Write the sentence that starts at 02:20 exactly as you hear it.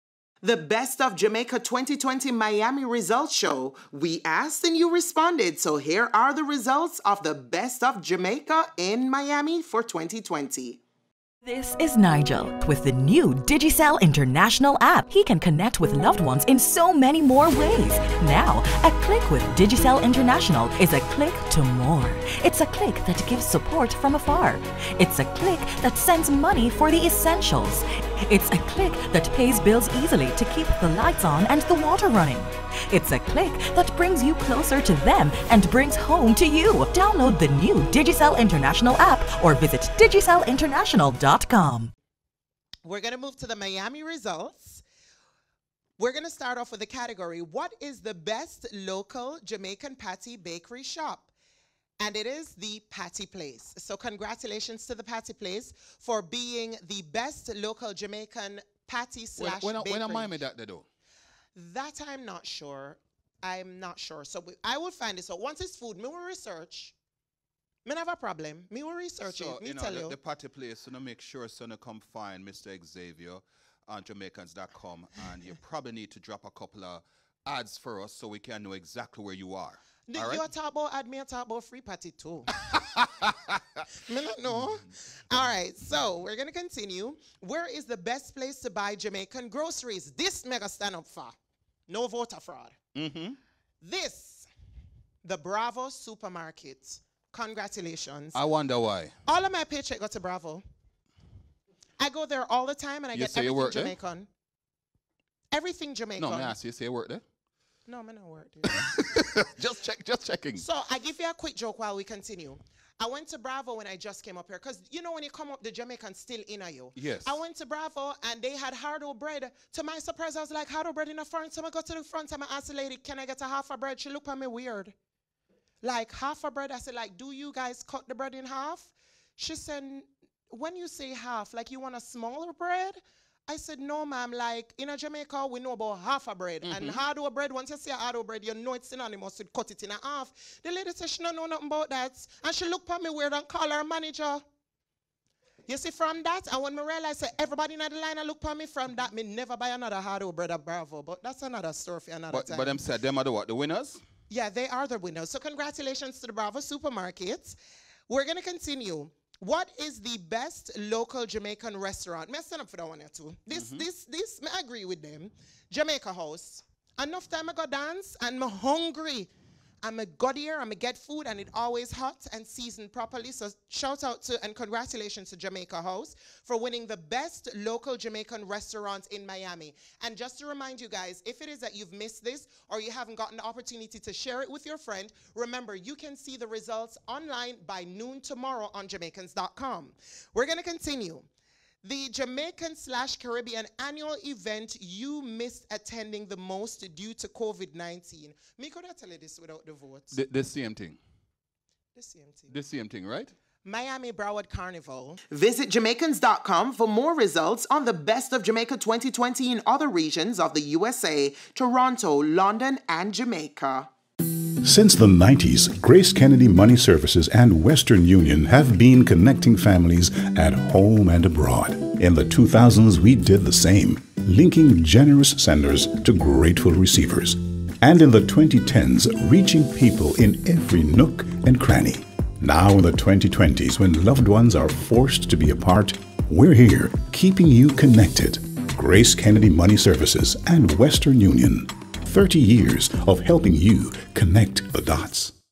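The lady said she don't know nothing about that.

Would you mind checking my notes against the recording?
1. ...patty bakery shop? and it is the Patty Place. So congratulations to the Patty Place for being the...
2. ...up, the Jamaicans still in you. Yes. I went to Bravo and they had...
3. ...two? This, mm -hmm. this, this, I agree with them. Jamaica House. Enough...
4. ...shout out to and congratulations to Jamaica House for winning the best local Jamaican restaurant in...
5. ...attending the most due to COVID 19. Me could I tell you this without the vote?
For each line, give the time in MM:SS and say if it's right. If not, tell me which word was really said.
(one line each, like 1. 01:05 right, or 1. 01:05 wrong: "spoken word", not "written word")
1. 00:49 right
2. 01:55 right
3. 02:43 right
4. 02:53 right
5. 03:15 right.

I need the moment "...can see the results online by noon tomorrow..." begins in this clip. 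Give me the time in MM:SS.
03:05.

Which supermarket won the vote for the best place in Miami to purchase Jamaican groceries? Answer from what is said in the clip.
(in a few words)
Bravo Supermarket.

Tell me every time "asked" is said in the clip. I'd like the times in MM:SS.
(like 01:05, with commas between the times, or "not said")
00:04, 02:02.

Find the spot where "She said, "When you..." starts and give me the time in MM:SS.
02:09.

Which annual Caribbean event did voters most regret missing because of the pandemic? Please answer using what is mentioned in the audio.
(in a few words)
Miami Broward Carnival.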